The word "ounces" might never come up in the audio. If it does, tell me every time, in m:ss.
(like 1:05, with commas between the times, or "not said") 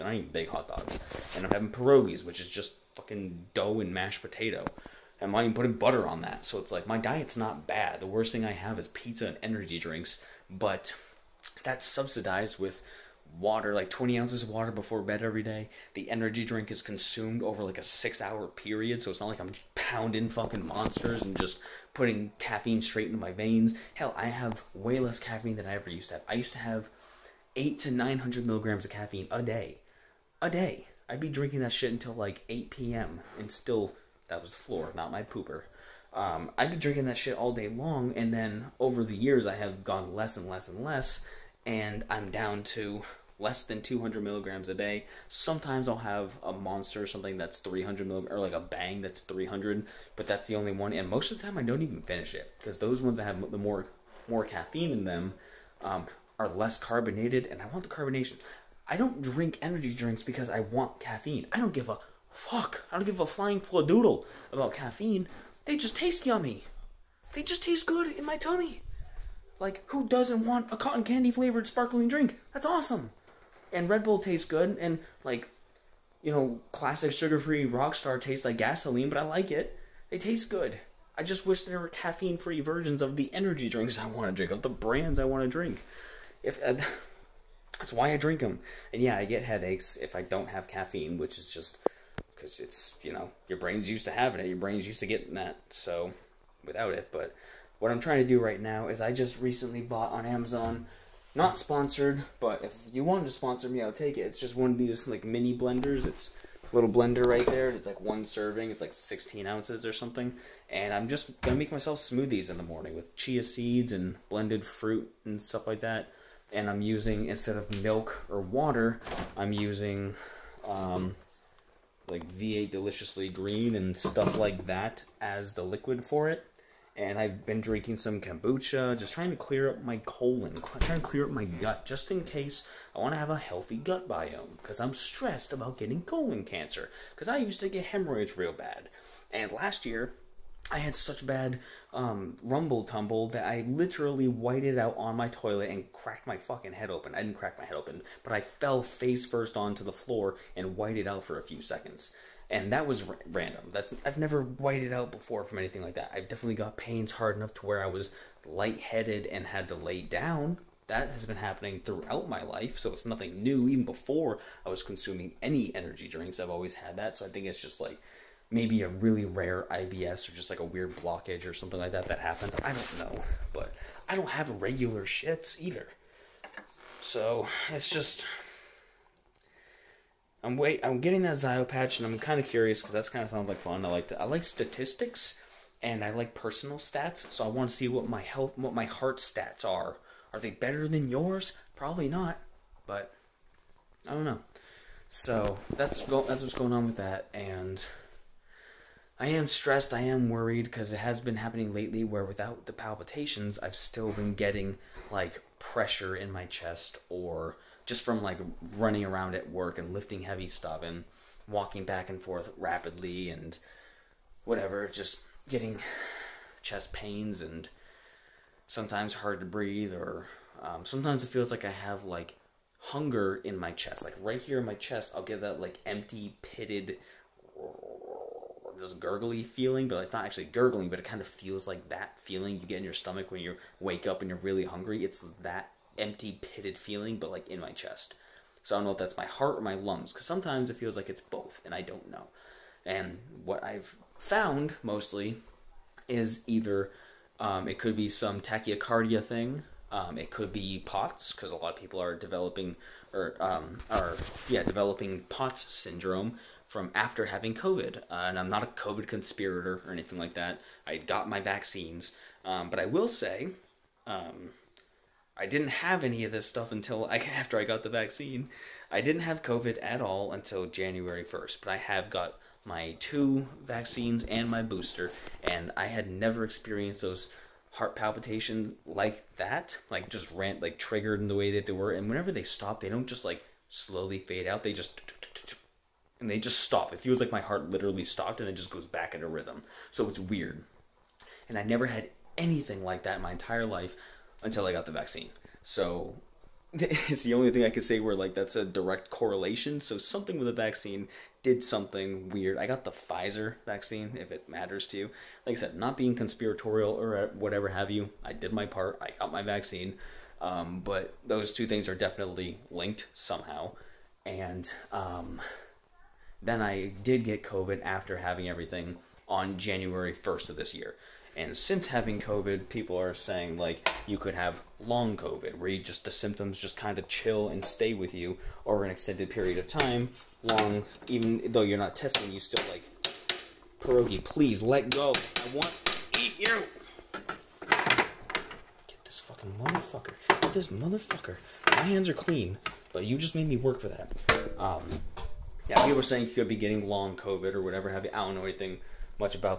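0:14, 1:49.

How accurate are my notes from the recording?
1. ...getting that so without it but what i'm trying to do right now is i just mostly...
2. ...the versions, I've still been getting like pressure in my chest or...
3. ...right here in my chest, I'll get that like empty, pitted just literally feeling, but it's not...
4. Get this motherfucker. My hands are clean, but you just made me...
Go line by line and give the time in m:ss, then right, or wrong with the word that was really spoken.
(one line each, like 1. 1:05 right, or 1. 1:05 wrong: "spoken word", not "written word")
1. 1:35 wrong: "recently", not "mostly"
2. 3:22 wrong: "palpitations", not "versions"
3. 3:44 wrong: "gurgly", not "literally"
4. 5:40 right.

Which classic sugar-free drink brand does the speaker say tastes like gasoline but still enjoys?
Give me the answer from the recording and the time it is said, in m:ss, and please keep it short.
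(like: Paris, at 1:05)
Rockstar, at 1:17.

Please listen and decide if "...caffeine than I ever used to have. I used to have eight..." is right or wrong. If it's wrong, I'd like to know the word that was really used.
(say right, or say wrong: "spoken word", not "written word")
right.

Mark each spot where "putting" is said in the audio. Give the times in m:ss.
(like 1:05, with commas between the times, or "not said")
0:05, 0:21.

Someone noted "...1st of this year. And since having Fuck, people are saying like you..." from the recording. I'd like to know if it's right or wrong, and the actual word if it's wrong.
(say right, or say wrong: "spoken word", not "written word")
wrong: "COVID", not "Fuck".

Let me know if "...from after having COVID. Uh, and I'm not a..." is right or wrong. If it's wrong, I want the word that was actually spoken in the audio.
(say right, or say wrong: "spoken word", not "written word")
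right.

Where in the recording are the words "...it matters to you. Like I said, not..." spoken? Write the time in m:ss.
5:04.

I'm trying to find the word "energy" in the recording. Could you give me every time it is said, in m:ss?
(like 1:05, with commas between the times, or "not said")
0:09, 0:16, 0:59, 1:23, 2:45.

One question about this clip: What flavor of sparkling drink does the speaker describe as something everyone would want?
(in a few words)
Cotton candy.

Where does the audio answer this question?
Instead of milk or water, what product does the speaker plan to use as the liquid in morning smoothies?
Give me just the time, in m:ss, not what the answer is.
2:02.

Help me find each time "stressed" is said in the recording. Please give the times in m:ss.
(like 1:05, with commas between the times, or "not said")
2:14, 3:19.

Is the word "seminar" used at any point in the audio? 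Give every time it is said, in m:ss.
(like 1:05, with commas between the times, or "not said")
not said.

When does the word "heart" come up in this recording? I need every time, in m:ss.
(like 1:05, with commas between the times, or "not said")
3:08, 3:59, 4:37, 4:47.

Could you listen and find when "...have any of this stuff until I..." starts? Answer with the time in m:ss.
4:25.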